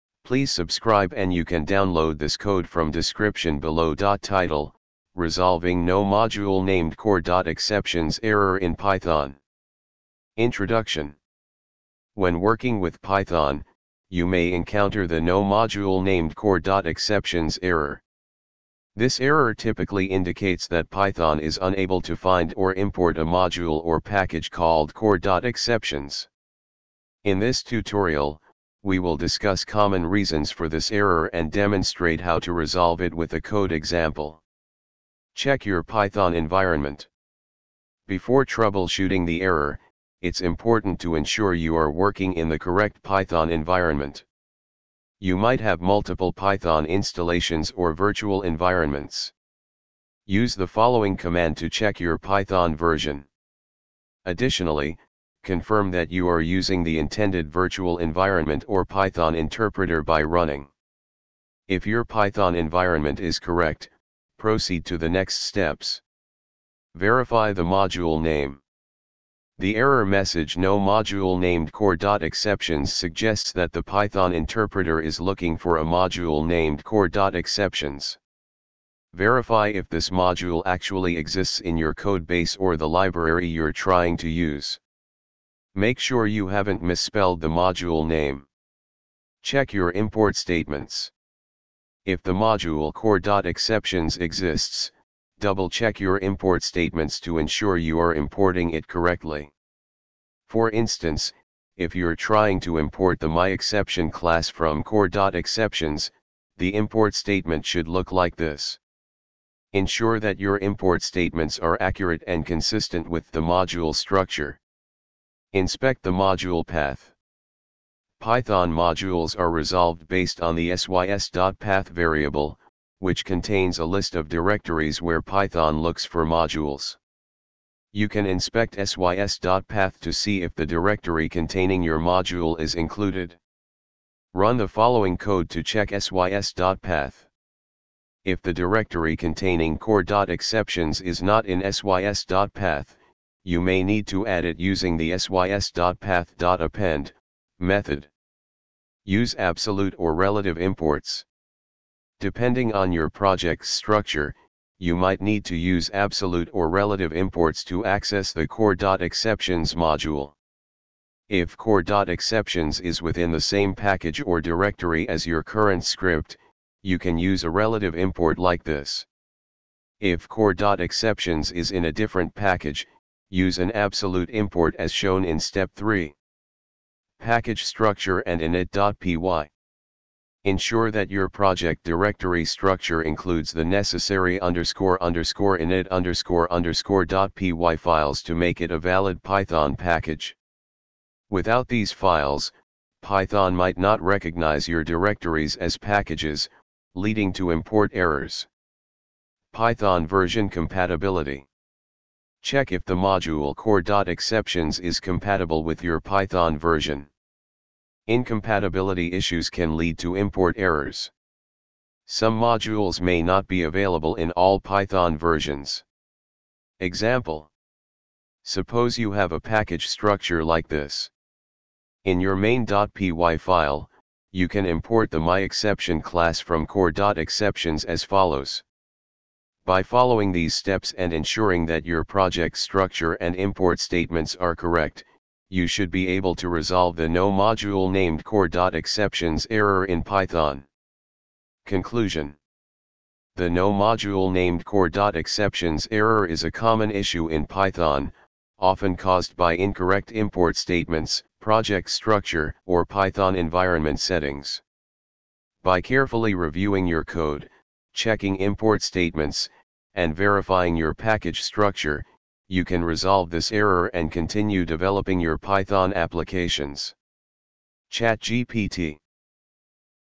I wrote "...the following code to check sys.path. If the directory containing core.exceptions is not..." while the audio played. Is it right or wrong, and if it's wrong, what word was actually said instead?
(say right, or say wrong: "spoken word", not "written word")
right.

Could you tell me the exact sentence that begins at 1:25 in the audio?
Make sure you haven't misspelled the module name.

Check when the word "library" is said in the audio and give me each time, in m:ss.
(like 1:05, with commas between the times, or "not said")
1:22.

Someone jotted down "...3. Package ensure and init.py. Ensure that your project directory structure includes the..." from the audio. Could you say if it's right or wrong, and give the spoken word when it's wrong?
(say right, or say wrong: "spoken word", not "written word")
wrong: "structure", not "ensure".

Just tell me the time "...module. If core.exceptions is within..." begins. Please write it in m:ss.
2:39.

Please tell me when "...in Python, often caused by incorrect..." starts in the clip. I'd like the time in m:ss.
4:07.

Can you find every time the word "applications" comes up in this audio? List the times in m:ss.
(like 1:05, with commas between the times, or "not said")
4:25.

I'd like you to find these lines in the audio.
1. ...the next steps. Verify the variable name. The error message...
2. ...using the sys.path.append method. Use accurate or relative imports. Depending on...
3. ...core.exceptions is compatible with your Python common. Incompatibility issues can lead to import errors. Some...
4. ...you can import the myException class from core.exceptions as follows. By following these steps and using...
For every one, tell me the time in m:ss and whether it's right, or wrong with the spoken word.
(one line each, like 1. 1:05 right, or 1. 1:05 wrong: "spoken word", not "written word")
1. 1:04 wrong: "module", not "variable"
2. 2:24 wrong: "absolute", not "accurate"
3. 3:23 wrong: "version", not "common"
4. 3:44 wrong: "ensuring", not "using".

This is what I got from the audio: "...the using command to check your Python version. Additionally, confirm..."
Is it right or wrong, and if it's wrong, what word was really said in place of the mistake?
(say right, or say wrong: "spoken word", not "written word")
wrong: "following", not "using".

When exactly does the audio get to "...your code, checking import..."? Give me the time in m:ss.
4:16.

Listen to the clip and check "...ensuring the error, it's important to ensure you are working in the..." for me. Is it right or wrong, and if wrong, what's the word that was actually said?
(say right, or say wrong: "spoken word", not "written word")
wrong: "troubleshooting", not "ensuring".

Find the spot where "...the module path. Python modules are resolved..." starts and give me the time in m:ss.
1:56.